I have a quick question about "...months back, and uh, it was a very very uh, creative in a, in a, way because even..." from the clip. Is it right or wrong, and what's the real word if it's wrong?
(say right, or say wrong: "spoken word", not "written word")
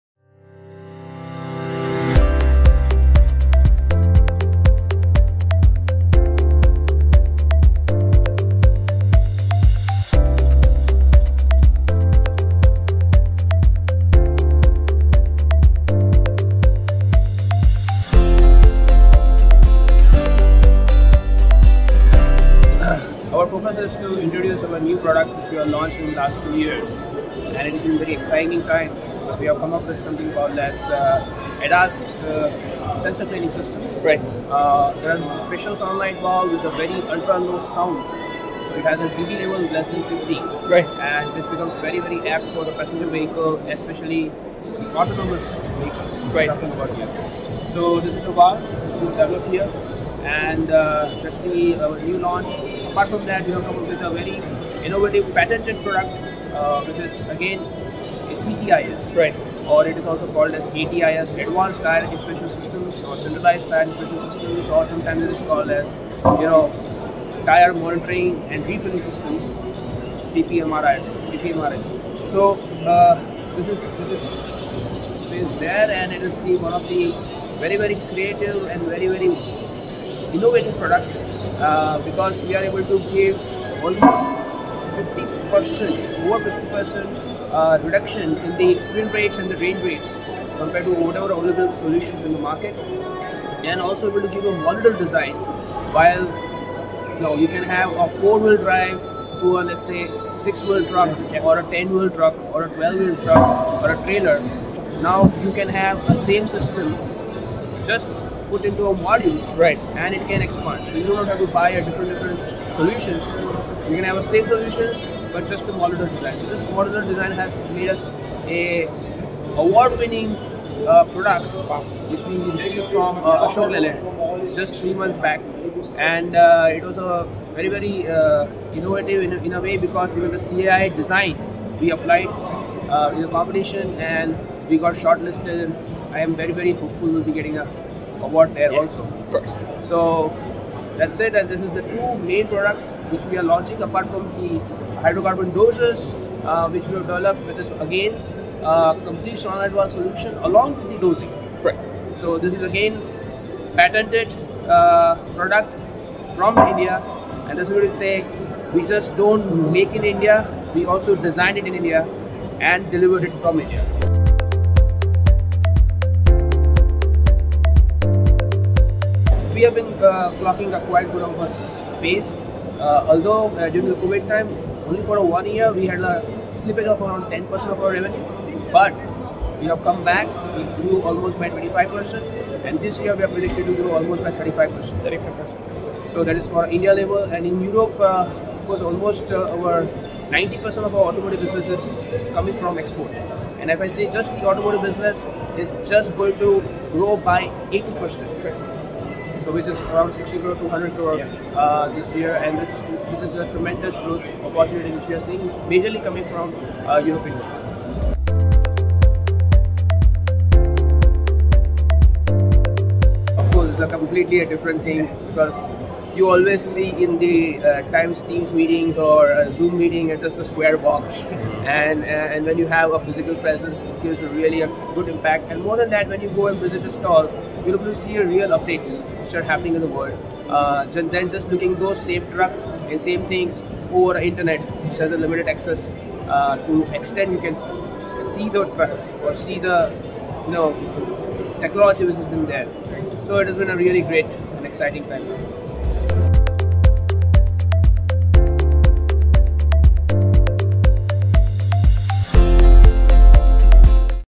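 wrong: "innovative", not "creative".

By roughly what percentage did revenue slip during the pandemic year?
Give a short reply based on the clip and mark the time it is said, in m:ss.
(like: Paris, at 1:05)
10%, at 2:56.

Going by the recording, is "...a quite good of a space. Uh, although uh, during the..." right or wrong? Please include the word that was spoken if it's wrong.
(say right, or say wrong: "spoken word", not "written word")
right.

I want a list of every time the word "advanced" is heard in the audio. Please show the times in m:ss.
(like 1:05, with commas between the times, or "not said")
1:01, 2:29.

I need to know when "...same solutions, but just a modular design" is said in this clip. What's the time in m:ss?
1:54.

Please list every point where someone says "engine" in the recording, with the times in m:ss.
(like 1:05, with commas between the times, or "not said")
not said.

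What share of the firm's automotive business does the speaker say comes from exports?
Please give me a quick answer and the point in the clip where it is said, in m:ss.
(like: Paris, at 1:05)
over 90%, at 3:09.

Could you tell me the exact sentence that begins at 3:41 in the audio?
And uh, and when you have a physical presence, it gives a really a good impact.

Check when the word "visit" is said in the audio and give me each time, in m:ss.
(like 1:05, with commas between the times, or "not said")
3:46.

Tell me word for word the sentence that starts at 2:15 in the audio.
And I am very very hopeful we'll be getting a award there yeah, also.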